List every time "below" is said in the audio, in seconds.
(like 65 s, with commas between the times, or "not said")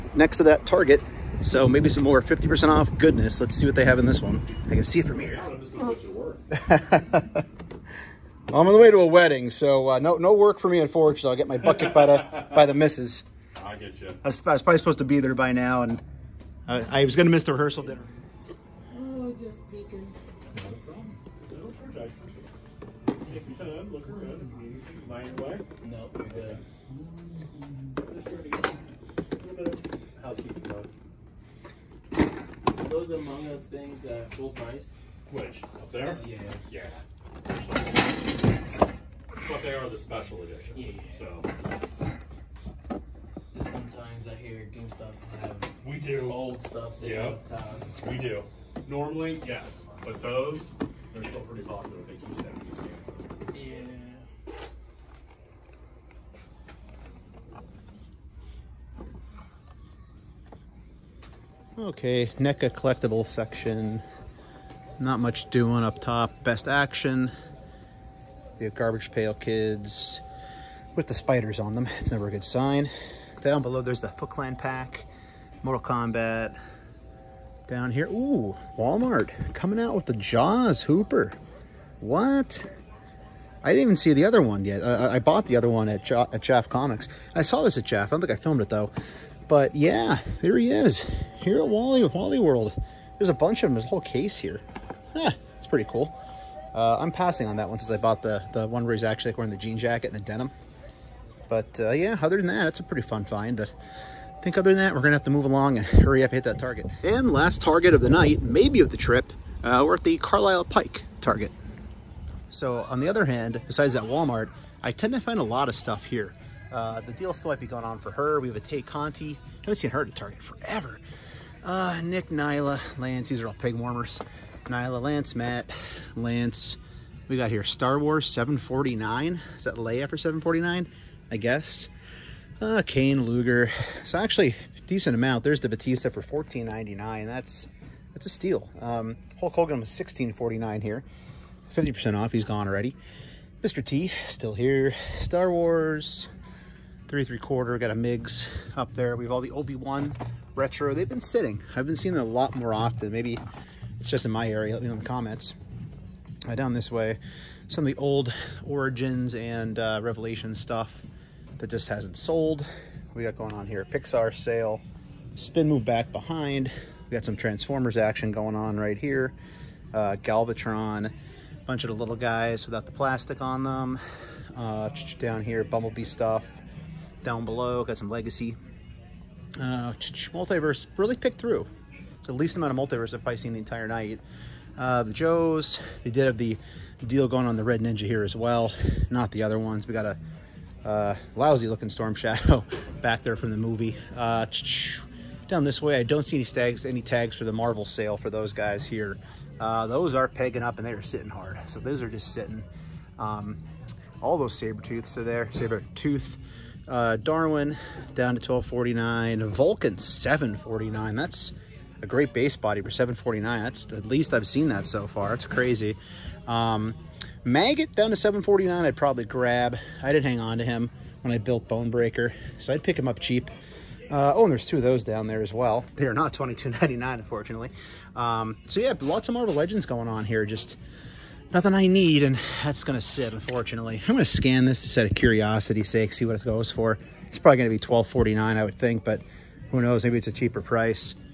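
73 s, 177 s.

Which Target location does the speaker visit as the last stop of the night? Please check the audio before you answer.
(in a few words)
Carlisle Pike.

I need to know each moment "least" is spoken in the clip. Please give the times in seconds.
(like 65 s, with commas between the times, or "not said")
182 s, 214 s.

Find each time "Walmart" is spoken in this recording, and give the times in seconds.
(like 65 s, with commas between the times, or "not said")
78 s, 114 s.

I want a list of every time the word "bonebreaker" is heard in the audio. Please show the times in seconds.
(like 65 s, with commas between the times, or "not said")
221 s.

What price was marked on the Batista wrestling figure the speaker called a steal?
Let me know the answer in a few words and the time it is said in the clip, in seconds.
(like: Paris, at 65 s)
$14.99, at 136 s.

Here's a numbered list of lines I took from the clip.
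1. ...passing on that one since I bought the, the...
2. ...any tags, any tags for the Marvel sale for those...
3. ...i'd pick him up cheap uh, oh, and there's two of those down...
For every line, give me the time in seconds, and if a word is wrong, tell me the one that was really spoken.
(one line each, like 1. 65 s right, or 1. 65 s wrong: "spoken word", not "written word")
1. 97 s right
2. 196 s right
3. 222 s right.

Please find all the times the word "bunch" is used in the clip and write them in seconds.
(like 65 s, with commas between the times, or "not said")
93 s, 171 s.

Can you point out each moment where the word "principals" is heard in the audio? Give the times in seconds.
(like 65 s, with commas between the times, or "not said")
not said.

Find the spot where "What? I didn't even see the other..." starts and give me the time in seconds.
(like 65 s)
82 s.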